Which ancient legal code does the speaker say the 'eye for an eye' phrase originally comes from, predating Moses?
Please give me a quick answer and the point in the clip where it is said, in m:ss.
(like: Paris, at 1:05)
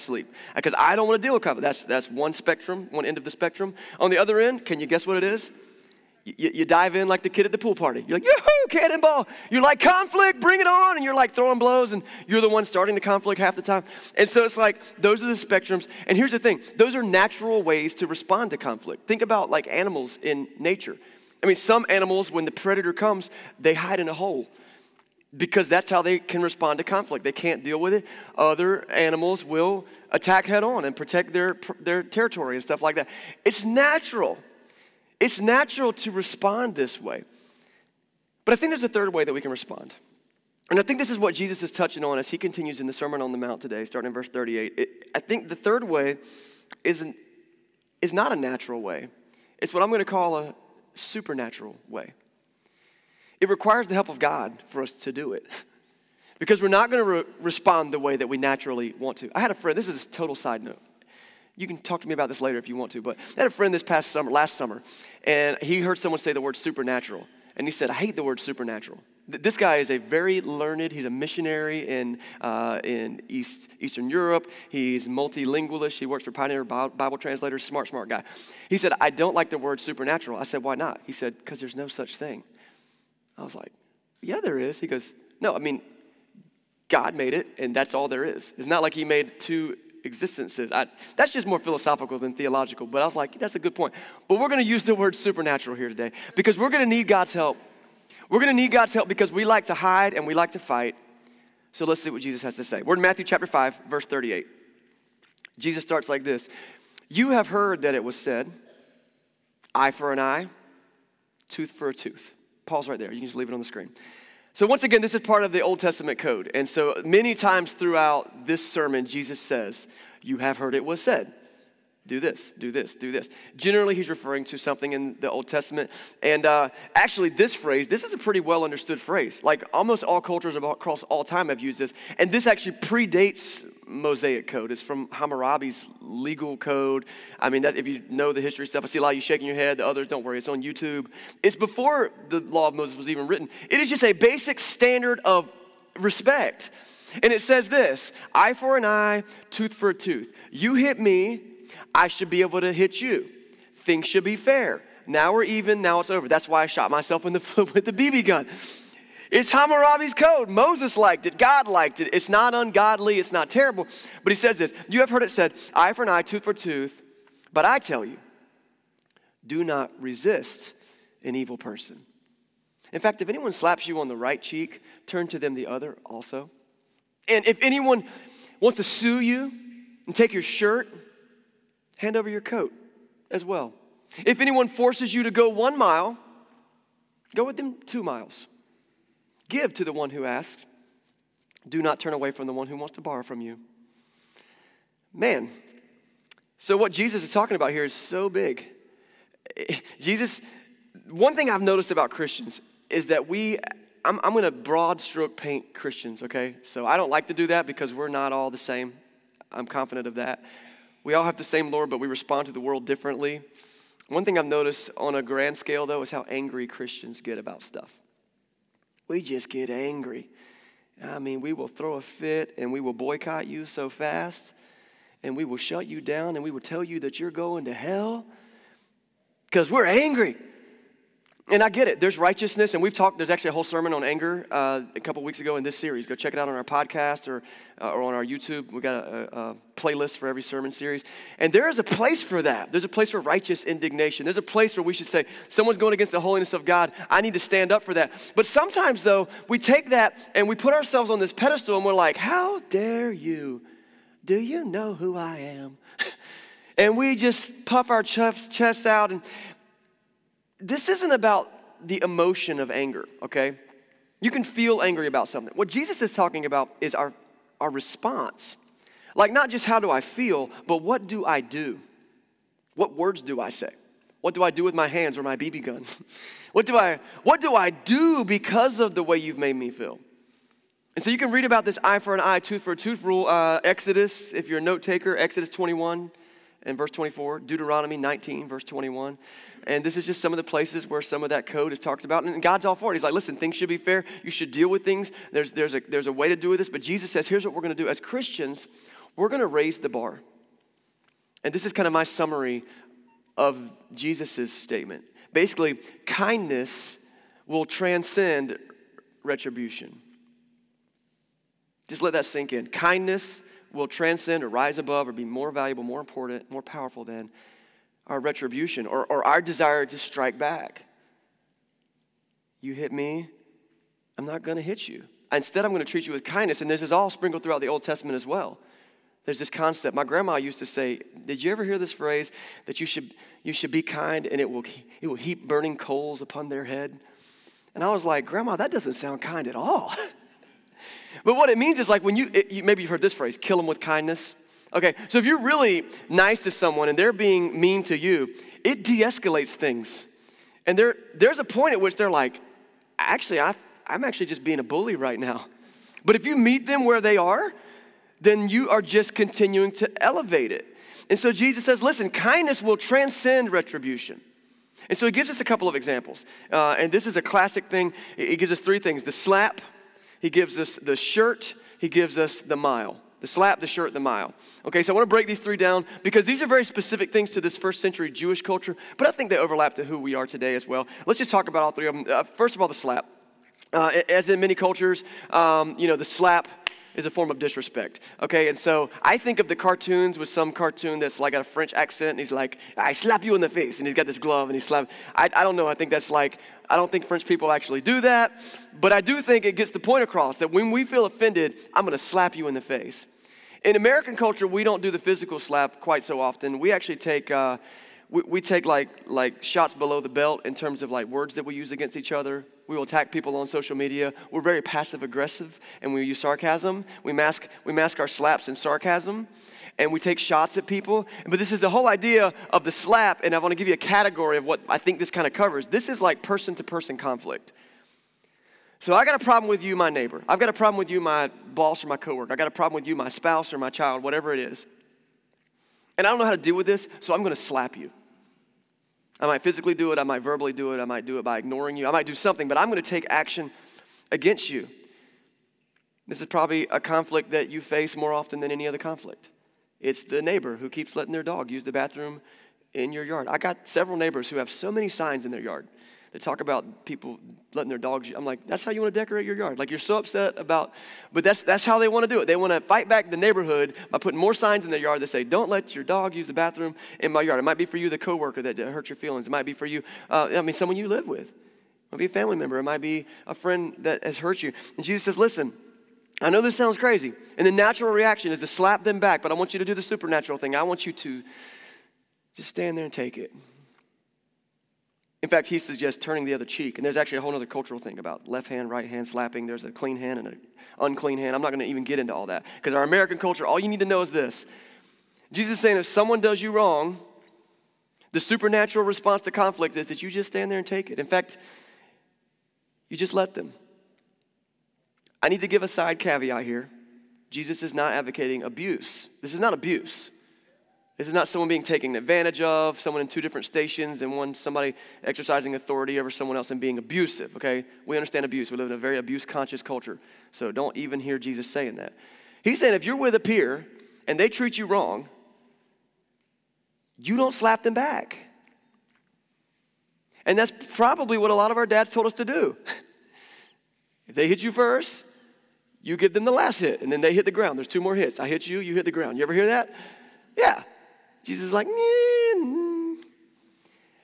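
Hammurabi's legal code, at 2:15.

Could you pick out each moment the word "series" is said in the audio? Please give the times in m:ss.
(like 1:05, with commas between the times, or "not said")
3:55, 4:00.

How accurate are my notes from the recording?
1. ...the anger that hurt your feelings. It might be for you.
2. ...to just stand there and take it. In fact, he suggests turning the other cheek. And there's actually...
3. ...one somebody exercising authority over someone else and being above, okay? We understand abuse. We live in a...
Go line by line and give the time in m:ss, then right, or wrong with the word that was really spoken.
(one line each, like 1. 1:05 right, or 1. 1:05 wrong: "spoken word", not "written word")
1. 7:47 wrong: "coworker", not "anger"
2. 8:00 right
3. 8:34 wrong: "abusive", not "above".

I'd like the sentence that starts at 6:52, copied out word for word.
We will attack people on social media.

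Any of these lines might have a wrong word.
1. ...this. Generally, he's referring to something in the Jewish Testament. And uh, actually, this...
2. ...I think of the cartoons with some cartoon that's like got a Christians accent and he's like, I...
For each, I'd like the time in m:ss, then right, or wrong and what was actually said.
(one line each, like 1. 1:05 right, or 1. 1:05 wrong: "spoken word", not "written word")
1. 2:03 wrong: "Old", not "Jewish"
2. 6:29 wrong: "French", not "Christians".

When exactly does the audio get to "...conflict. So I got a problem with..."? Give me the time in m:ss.
7:06.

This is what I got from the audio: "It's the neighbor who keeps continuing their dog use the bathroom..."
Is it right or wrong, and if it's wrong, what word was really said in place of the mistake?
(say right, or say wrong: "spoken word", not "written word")
wrong: "letting", not "continuing".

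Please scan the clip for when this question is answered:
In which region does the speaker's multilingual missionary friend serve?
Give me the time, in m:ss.
1:13.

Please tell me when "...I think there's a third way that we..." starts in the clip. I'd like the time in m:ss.
0:38.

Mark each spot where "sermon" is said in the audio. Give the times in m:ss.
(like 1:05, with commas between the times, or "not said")
0:42, 1:58, 3:53, 4:00.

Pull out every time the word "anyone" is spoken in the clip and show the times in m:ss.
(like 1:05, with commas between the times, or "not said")
2:53, 2:57, 3:04.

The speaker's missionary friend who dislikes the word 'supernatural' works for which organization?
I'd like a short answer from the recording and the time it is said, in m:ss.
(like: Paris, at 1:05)
Pioneer Bible Translators, at 1:16.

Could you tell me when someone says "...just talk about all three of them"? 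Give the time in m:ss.
6:21.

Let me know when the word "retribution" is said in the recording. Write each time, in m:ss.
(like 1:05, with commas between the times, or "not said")
5:09, 5:18, 6:03.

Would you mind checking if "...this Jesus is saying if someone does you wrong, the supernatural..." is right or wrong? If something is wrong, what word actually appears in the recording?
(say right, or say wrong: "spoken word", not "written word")
right.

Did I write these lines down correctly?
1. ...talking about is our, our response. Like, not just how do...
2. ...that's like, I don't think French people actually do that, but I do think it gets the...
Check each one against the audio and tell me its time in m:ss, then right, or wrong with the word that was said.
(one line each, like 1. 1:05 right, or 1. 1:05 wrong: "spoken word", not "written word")
1. 4:26 right
2. 6:35 right.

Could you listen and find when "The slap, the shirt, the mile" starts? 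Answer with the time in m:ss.
6:13.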